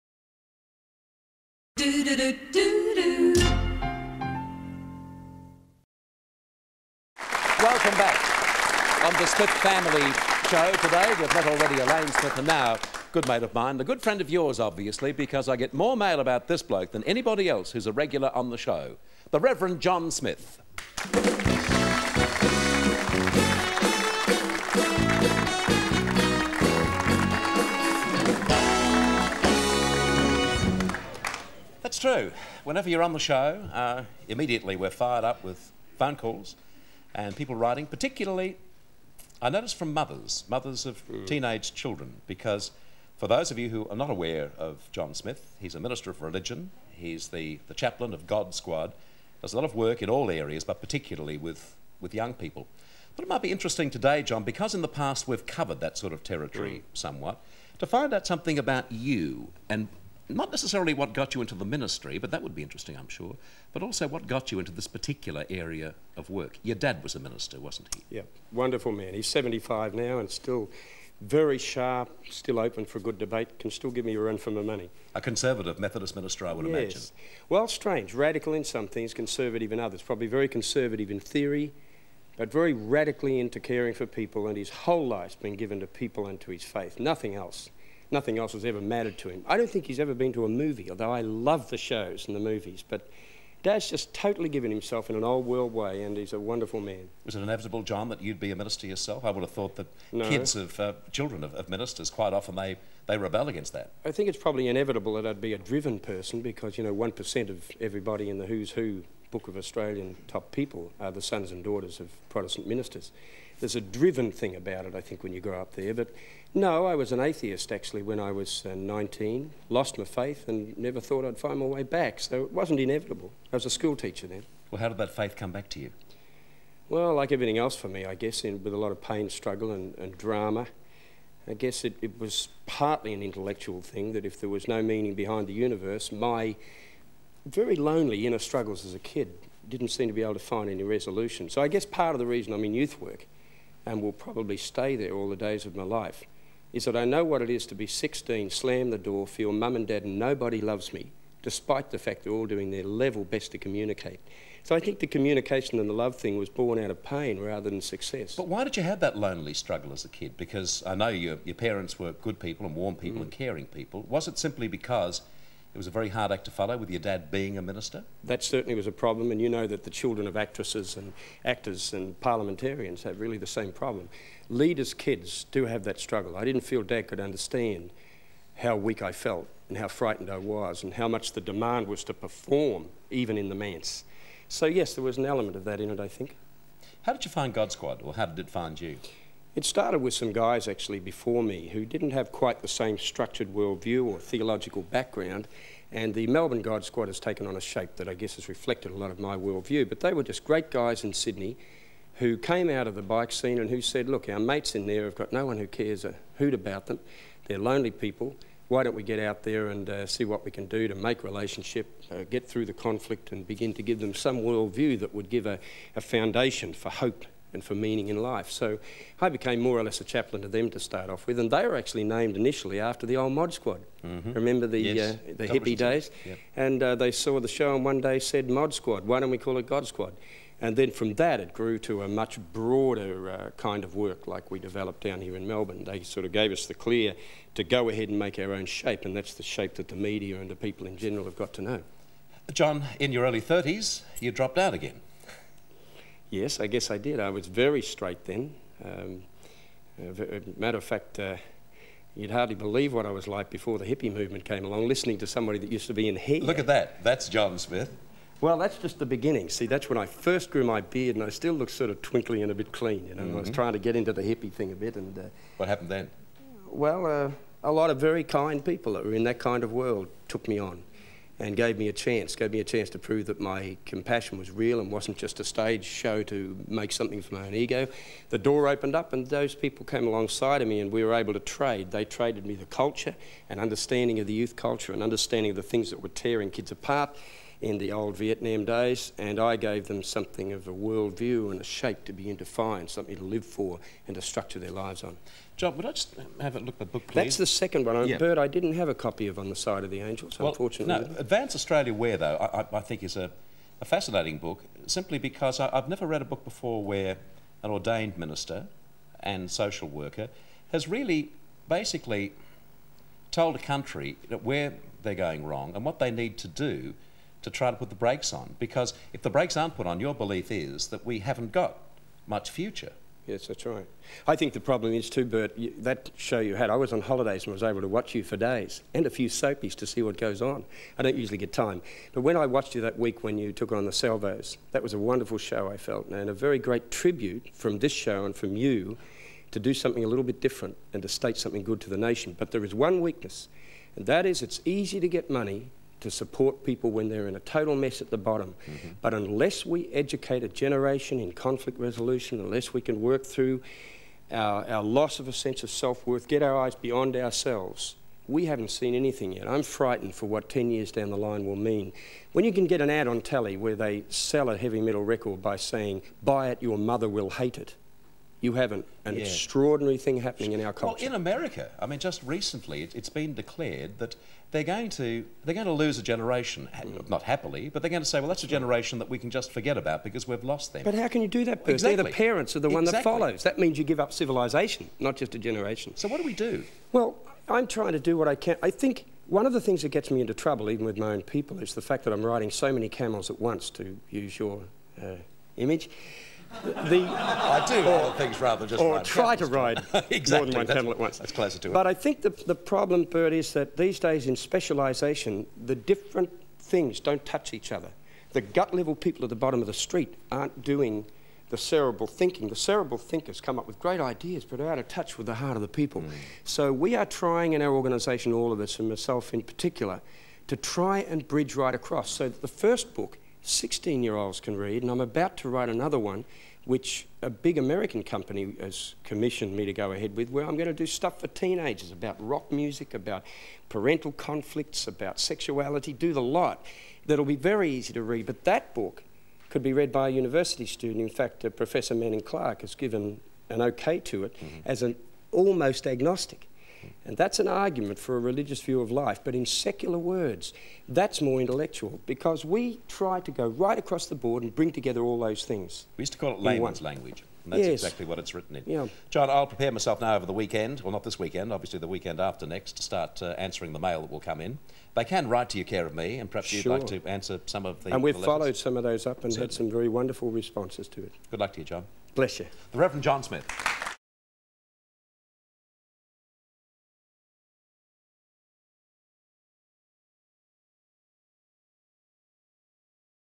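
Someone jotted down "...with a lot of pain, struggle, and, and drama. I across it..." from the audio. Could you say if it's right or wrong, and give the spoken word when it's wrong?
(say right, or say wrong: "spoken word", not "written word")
wrong: "guess", not "across".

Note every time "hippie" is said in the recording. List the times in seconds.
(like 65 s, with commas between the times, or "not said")
225 s, 253 s, 264 s.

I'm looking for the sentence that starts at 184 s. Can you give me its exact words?
So, yes, there was an element of that in it, I think.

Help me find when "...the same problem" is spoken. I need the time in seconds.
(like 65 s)
173 s.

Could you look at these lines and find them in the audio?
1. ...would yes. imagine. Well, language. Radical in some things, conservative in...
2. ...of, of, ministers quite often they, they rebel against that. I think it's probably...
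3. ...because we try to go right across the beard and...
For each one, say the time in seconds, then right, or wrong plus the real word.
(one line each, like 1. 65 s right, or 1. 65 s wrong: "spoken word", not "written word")
1. 76 s wrong: "strange", not "language"
2. 101 s right
3. 452 s wrong: "board", not "beard".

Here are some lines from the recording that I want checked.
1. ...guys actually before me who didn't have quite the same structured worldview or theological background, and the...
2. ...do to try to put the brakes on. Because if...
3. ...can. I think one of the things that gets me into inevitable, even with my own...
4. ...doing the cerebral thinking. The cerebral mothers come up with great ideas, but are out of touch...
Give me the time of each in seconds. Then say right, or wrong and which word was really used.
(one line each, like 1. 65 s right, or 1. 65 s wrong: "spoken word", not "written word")
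1. 190 s right
2. 316 s right
3. 388 s wrong: "trouble", not "inevitable"
4. 410 s wrong: "thinkers", not "mothers".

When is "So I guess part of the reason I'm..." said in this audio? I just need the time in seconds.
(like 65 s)
141 s.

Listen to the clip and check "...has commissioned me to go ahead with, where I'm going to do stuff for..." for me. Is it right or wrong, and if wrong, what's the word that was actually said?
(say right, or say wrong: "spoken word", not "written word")
right.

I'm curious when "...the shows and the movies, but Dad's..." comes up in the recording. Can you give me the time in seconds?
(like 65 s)
91 s.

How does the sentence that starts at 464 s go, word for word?
They can write to your care of me, and perhaps sure.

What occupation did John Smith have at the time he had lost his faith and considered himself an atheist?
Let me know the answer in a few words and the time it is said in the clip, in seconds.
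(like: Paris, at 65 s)
school teacher, at 123 s.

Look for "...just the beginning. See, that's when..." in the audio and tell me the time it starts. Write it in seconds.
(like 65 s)
258 s.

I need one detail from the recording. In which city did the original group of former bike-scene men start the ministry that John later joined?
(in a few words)
Sydney.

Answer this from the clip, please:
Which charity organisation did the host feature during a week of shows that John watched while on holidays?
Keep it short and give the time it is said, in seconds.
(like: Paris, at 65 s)
the Salvos, at 333 s.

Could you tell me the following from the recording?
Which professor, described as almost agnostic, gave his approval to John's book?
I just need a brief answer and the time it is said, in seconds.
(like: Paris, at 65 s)
Manning Clark, at 441 s.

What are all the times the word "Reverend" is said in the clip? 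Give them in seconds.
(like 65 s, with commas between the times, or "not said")
19 s, 472 s.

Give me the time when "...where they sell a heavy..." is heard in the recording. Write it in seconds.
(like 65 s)
363 s.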